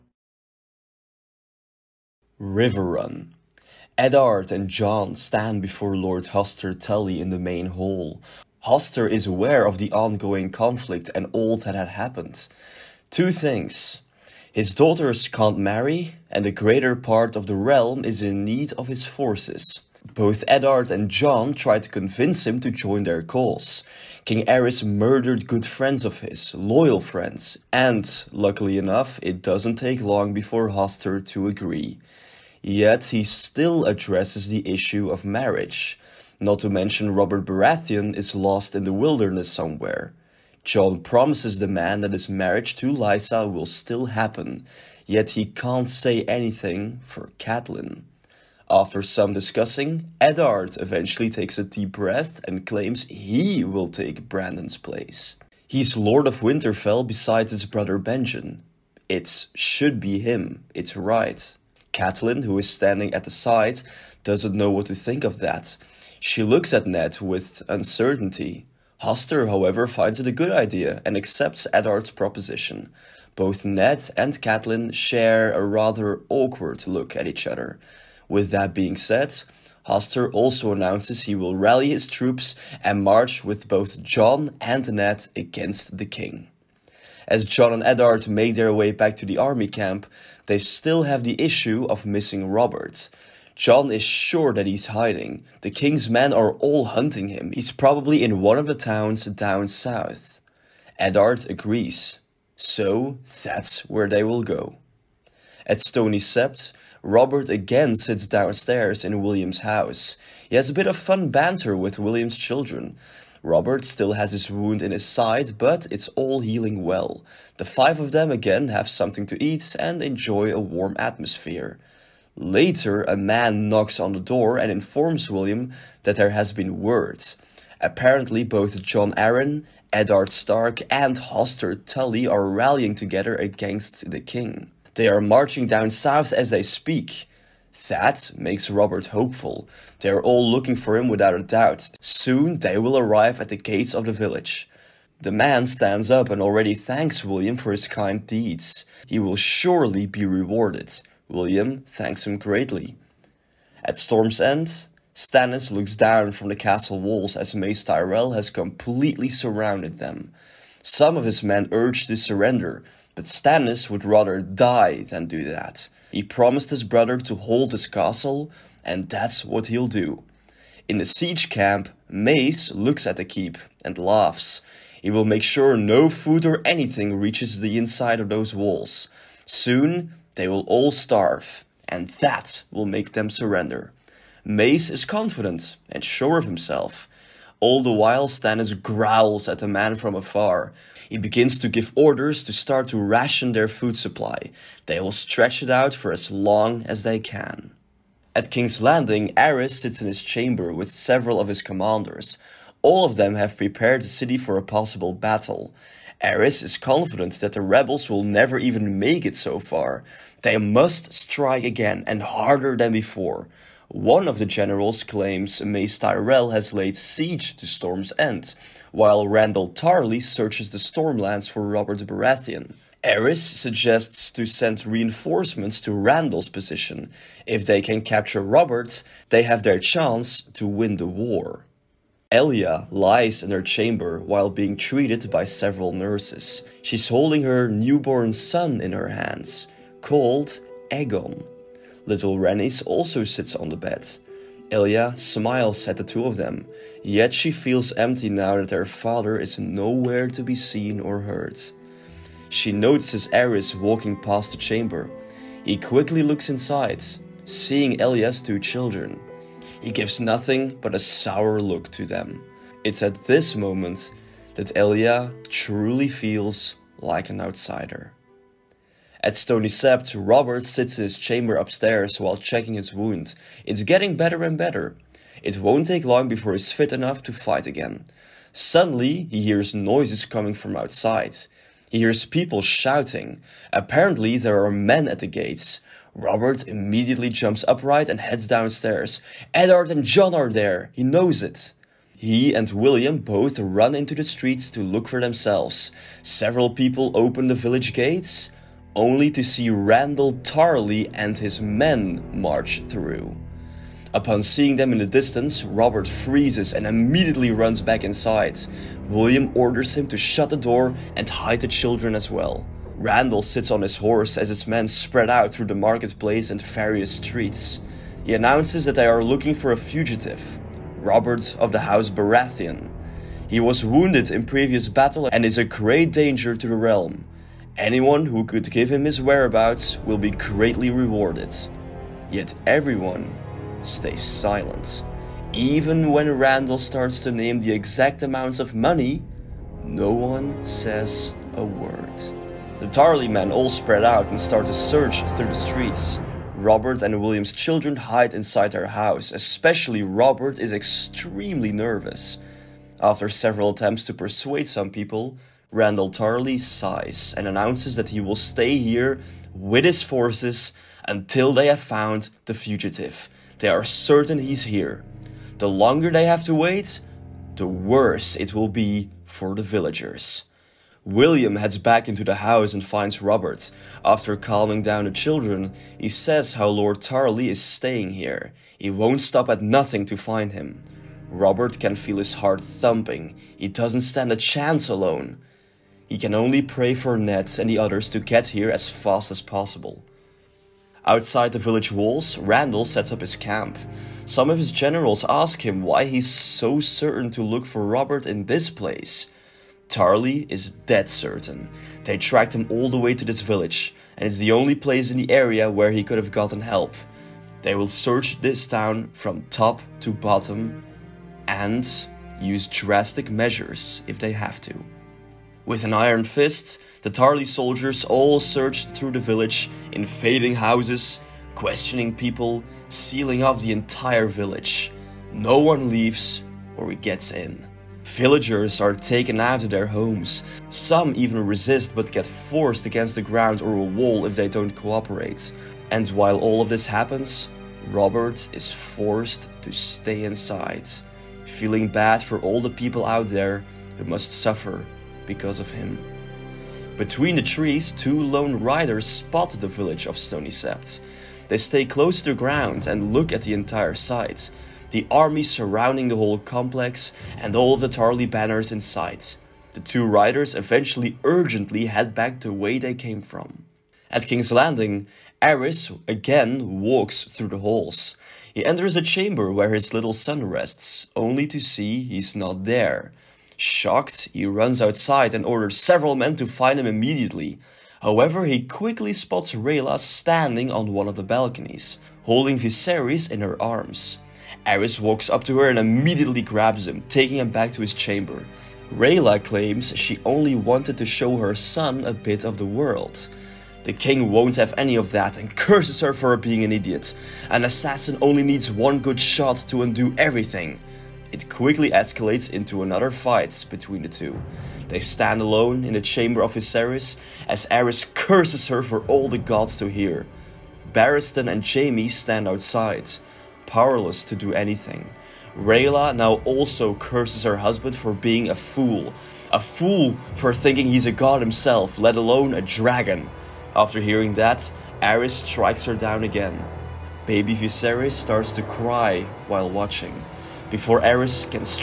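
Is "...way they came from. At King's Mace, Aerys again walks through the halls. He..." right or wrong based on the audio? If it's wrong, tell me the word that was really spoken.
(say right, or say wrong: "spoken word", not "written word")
wrong: "Landing", not "Mace".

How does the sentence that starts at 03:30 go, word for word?
They must strike again and harder than before.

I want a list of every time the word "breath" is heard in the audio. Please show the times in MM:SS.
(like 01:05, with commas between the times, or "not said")
00:51.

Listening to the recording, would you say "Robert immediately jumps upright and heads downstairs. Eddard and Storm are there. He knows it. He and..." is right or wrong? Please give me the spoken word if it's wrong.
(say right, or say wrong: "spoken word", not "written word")
wrong: "Jon", not "Storm".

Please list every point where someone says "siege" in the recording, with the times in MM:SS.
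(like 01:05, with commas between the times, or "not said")
02:51, 03:36.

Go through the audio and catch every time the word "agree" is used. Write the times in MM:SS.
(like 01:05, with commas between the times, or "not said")
00:31, 01:41.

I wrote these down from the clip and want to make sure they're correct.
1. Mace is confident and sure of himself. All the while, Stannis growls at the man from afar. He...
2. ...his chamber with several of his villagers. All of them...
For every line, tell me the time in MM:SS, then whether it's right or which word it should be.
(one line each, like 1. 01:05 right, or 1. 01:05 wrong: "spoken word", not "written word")
1. 03:04 right
2. 03:20 wrong: "commanders", not "villagers".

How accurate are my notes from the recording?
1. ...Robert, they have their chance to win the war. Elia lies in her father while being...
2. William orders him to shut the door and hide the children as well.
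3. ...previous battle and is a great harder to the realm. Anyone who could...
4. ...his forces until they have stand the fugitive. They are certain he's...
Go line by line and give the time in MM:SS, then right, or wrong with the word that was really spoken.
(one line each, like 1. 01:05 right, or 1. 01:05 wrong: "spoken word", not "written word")
1. 03:48 wrong: "chamber", not "father"
2. 05:09 right
3. 05:24 wrong: "danger", not "harder"
4. 05:59 wrong: "found", not "stand".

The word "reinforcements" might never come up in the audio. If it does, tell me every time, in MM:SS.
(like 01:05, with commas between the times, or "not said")
03:44.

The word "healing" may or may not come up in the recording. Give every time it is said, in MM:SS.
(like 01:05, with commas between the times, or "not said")
01:56.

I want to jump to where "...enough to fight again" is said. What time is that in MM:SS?
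04:36.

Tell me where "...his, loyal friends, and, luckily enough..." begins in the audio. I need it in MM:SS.
00:26.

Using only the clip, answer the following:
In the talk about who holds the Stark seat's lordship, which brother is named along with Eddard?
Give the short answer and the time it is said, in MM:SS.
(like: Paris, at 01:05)
Benjen, at 00:57.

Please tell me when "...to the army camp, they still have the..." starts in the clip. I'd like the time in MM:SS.
01:29.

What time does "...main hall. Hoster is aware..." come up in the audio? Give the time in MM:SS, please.
00:07.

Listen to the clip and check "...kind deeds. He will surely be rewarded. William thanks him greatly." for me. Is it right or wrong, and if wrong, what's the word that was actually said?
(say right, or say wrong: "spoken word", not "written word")
right.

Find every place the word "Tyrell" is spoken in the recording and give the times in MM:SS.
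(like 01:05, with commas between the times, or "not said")
02:37, 03:35.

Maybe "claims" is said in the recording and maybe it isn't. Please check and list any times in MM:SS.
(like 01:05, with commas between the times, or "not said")
00:52, 03:35, 08:09.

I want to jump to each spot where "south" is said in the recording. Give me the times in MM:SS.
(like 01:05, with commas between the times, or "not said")
01:39, 02:15.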